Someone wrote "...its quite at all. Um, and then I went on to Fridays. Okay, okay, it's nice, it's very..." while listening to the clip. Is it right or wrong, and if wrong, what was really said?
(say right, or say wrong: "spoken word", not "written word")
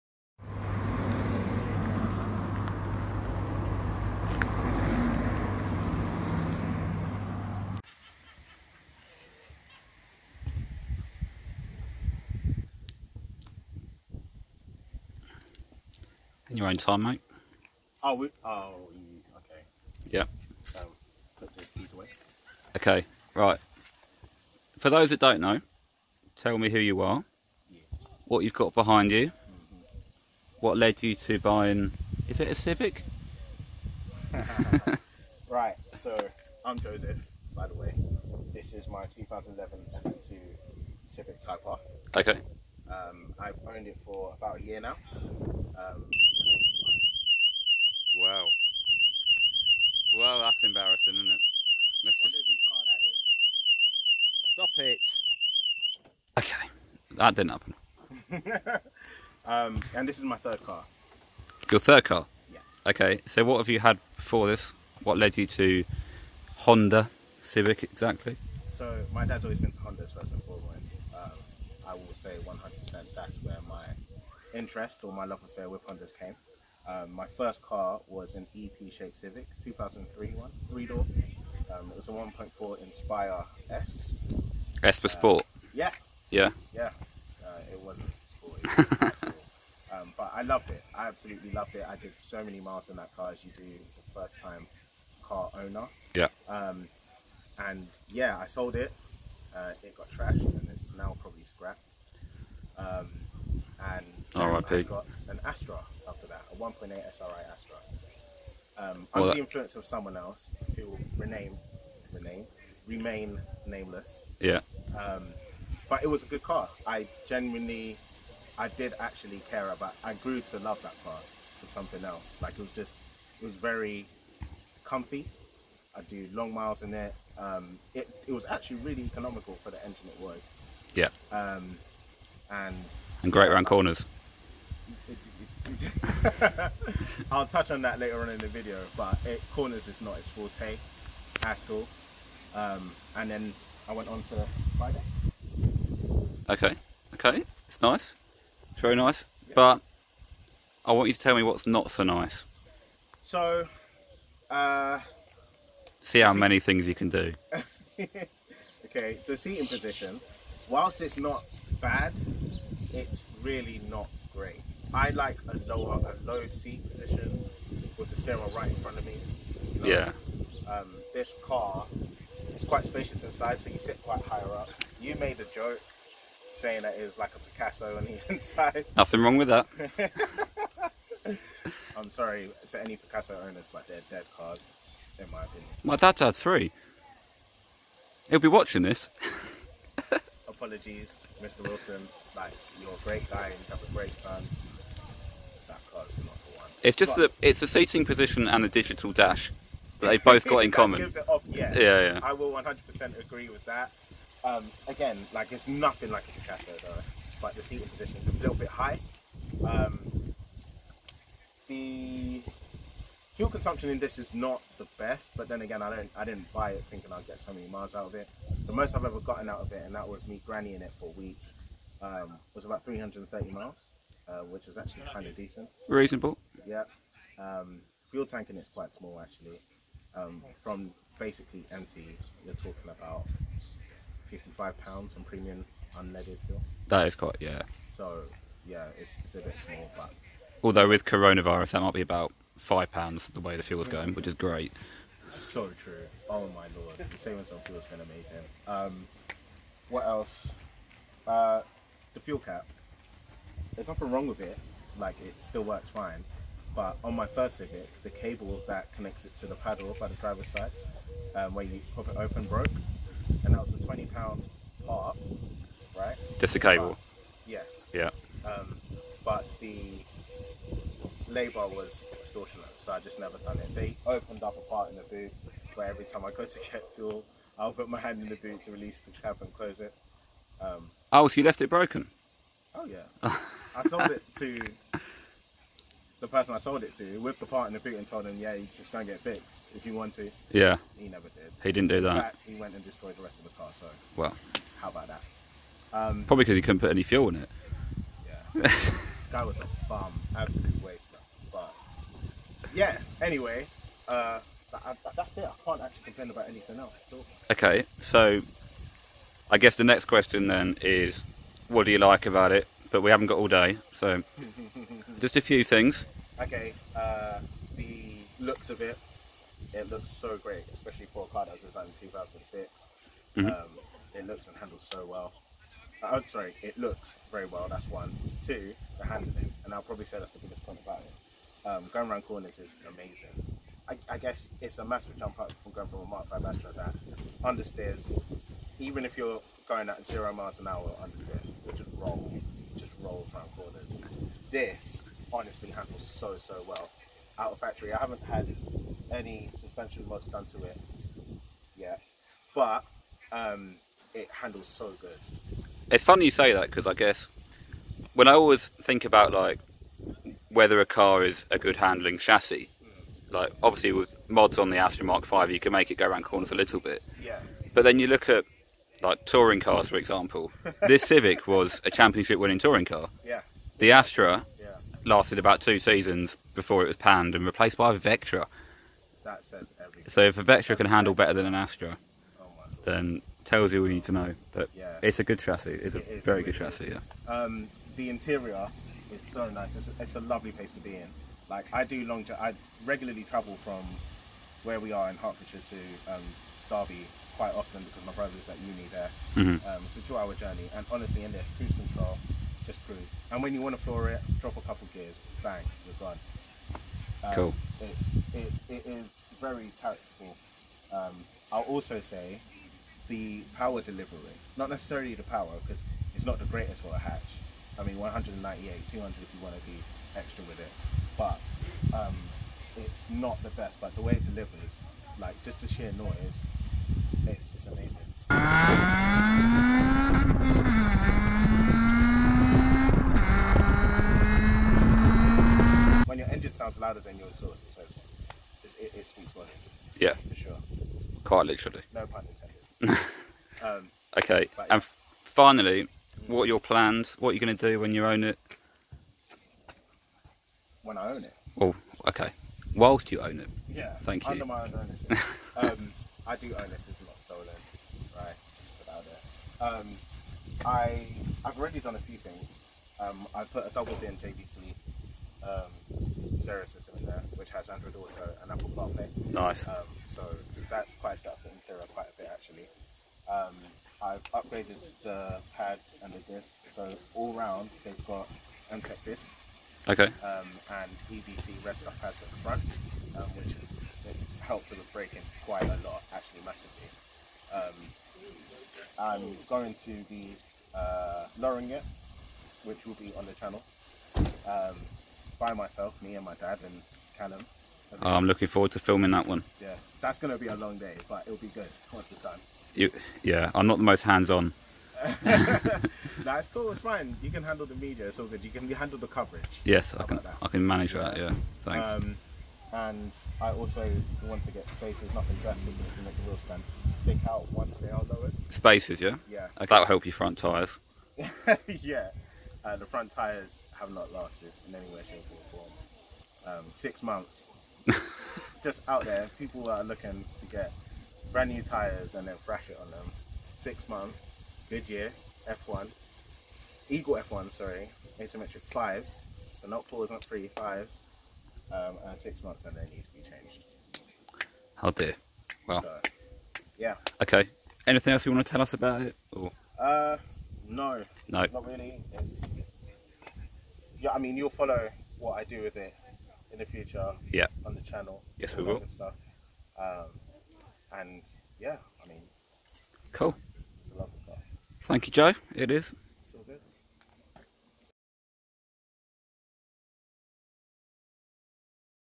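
wrong: "forte", not "quite".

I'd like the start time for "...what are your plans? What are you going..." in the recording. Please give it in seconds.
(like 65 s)
446 s.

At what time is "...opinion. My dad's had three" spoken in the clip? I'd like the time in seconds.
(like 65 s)
185 s.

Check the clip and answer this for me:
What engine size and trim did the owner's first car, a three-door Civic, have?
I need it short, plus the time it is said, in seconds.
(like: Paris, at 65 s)
1.4 Inspire S, at 82 s.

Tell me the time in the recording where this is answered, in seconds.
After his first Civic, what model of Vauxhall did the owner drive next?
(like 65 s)
106 s.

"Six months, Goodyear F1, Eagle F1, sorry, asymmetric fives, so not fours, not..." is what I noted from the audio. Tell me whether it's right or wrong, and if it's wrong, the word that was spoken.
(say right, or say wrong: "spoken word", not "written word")
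right.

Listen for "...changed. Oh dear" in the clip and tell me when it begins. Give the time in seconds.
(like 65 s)
543 s.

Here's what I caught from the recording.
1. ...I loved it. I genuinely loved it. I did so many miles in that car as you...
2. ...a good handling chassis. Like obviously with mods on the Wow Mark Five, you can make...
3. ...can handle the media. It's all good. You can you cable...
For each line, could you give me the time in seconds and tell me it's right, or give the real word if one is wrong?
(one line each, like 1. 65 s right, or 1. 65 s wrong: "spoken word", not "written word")
1. 90 s wrong: "absolutely", not "genuinely"
2. 361 s wrong: "Astra", not "Wow"
3. 507 s wrong: "handle", not "cable".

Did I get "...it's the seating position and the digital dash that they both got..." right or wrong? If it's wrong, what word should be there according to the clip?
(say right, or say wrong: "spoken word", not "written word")
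right.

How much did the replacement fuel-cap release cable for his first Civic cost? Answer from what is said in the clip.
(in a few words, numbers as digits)
20 pounds.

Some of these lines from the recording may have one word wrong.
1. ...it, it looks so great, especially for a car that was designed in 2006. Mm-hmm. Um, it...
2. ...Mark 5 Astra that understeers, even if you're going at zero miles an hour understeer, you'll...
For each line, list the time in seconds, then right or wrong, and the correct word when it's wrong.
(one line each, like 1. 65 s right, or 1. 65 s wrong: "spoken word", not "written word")
1. 318 s right
2. 336 s right.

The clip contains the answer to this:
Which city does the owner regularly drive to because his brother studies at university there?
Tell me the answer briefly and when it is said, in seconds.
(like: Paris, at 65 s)
Derby, at 396 s.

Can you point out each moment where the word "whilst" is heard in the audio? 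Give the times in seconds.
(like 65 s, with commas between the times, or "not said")
160 s, 452 s.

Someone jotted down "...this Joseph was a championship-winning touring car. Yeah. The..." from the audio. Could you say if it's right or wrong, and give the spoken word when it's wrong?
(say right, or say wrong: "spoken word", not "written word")
wrong: "Civic", not "Joseph".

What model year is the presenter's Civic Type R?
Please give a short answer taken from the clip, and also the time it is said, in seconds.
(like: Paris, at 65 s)
2011, at 39 s.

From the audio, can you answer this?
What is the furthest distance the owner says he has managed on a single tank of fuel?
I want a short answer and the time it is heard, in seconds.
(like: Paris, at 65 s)
330 miles, at 222 s.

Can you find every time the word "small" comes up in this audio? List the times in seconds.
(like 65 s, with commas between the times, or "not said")
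228 s, 239 s.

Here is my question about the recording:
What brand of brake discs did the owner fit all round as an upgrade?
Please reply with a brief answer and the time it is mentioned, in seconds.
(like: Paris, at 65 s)
MTEC, at 478 s.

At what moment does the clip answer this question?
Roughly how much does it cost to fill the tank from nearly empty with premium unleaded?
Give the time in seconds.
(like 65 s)
234 s.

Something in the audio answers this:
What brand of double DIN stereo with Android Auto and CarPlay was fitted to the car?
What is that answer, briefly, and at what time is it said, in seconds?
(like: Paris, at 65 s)
JVC, at 464 s.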